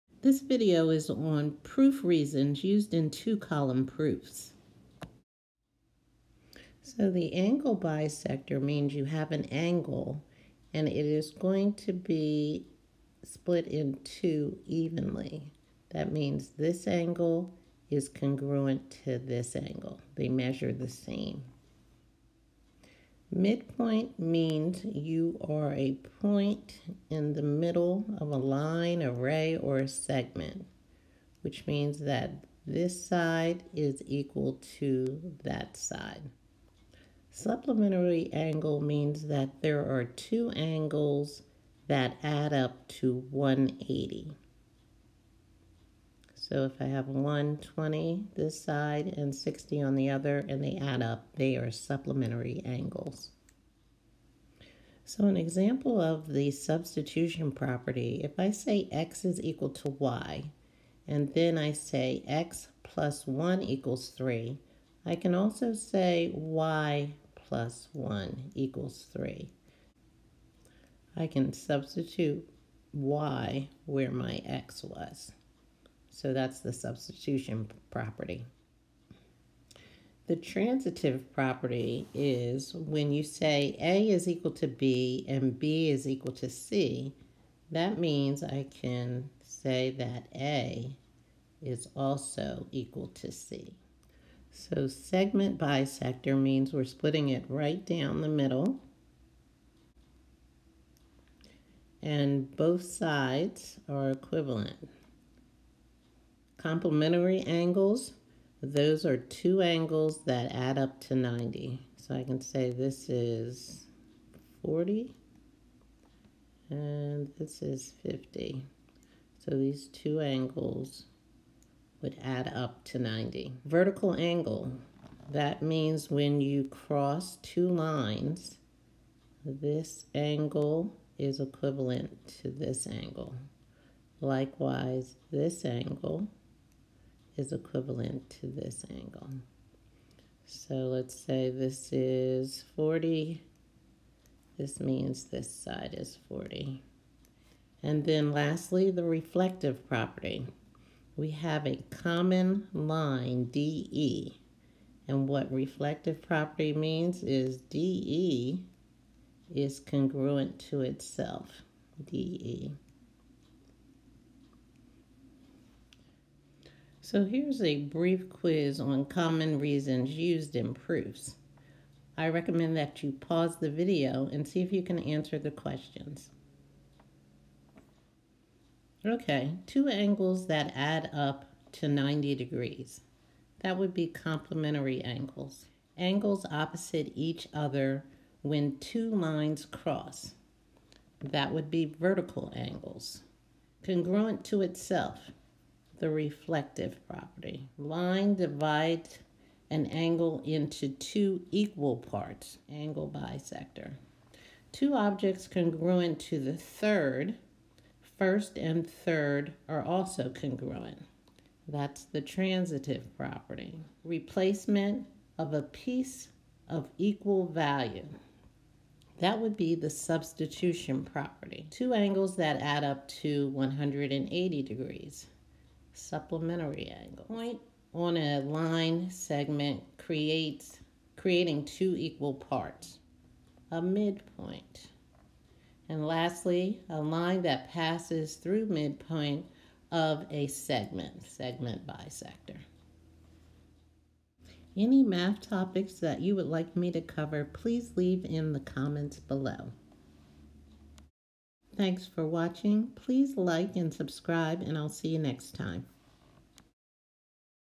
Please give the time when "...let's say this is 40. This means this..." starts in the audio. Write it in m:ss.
2:20.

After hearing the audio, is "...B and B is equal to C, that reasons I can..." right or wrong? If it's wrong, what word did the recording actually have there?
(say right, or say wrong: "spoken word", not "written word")
wrong: "means", not "reasons".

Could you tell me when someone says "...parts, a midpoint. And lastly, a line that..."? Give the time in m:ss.
3:52.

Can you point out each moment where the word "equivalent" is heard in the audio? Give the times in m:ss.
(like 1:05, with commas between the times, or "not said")
1:44, 2:11, 2:17.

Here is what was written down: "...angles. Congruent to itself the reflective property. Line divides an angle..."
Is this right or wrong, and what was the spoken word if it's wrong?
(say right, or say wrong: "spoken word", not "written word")
right.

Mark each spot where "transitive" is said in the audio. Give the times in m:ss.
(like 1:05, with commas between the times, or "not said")
1:20, 3:32.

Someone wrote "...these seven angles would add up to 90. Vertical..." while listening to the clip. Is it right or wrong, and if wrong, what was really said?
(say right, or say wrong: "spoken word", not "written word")
wrong: "two", not "seven".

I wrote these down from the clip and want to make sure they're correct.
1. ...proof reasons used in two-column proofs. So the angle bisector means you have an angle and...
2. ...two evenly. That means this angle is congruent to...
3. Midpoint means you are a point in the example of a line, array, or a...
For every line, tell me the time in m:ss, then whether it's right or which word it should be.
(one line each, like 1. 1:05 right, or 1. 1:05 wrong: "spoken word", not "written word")
1. 0:01 right
2. 0:14 right
3. 0:23 wrong: "middle", not "example".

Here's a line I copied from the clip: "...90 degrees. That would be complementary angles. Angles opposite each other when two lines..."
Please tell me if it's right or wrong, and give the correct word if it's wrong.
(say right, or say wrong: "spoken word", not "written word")
right.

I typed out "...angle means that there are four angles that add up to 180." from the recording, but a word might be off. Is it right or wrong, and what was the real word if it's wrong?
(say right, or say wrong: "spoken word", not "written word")
wrong: "two", not "four".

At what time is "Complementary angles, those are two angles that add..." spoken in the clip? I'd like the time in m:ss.
1:46.